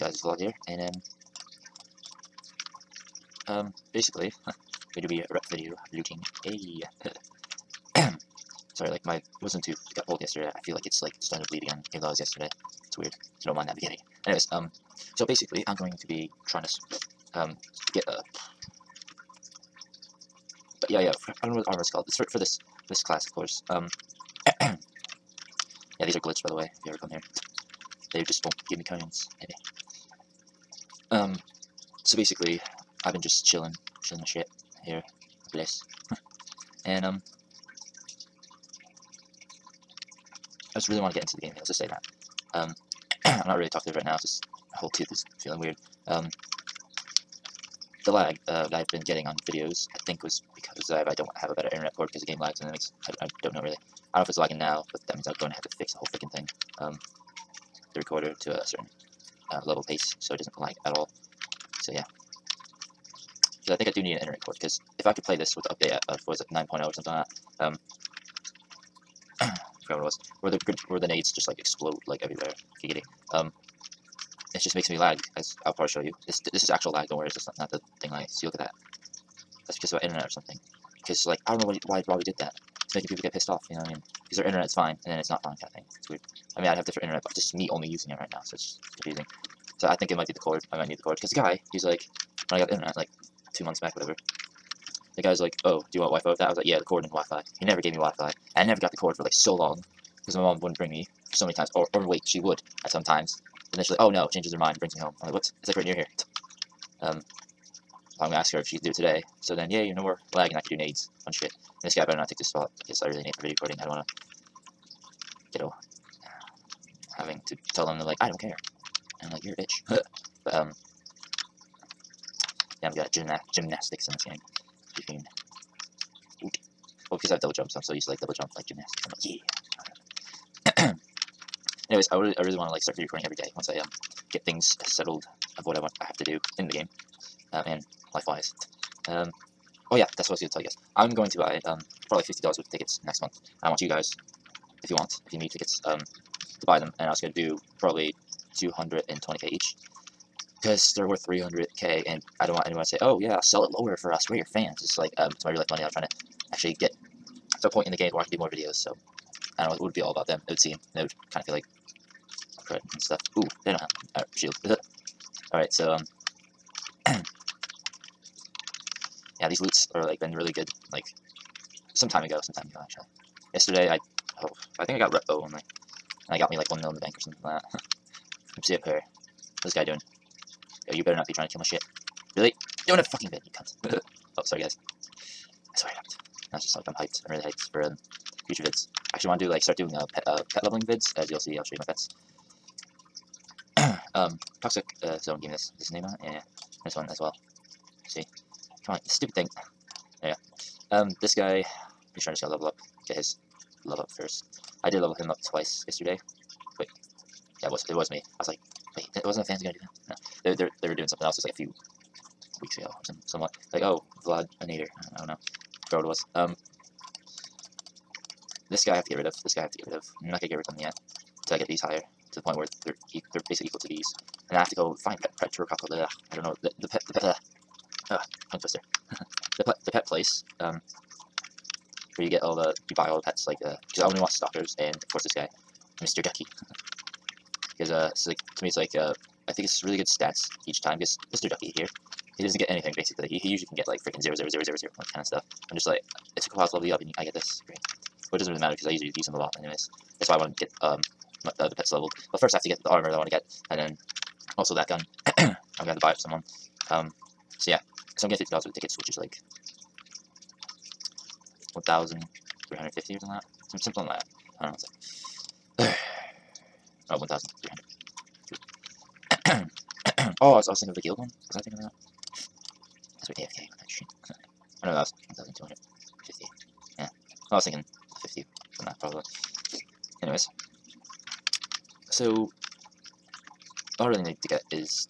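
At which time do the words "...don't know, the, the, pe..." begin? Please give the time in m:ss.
3:46.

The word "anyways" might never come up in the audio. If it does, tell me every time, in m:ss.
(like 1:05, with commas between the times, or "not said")
0:14, 2:11, 4:09, 4:40.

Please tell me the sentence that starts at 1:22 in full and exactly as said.
It's making people get pissed off, you know what I mean?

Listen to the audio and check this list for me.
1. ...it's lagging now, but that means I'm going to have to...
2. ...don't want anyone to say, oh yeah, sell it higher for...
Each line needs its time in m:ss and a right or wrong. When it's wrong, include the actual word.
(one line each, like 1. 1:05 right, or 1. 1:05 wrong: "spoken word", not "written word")
1. 0:54 right
2. 2:32 wrong: "lower", not "higher".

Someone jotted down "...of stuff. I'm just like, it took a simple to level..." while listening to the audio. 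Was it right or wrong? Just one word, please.
wrong.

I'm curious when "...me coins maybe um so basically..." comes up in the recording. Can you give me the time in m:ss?
0:28.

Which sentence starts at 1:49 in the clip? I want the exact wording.
So then, yay, no more lag and I could do nades on shit.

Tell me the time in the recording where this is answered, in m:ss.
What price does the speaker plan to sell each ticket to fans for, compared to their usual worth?
2:28.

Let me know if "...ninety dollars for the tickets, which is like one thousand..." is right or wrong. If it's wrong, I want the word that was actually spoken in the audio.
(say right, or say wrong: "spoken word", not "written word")
wrong: "fifty", not "ninety".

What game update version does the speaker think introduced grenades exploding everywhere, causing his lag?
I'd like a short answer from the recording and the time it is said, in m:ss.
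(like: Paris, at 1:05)
9.0, at 1:06.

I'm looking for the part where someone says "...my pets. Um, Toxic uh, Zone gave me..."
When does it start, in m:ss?
3:11.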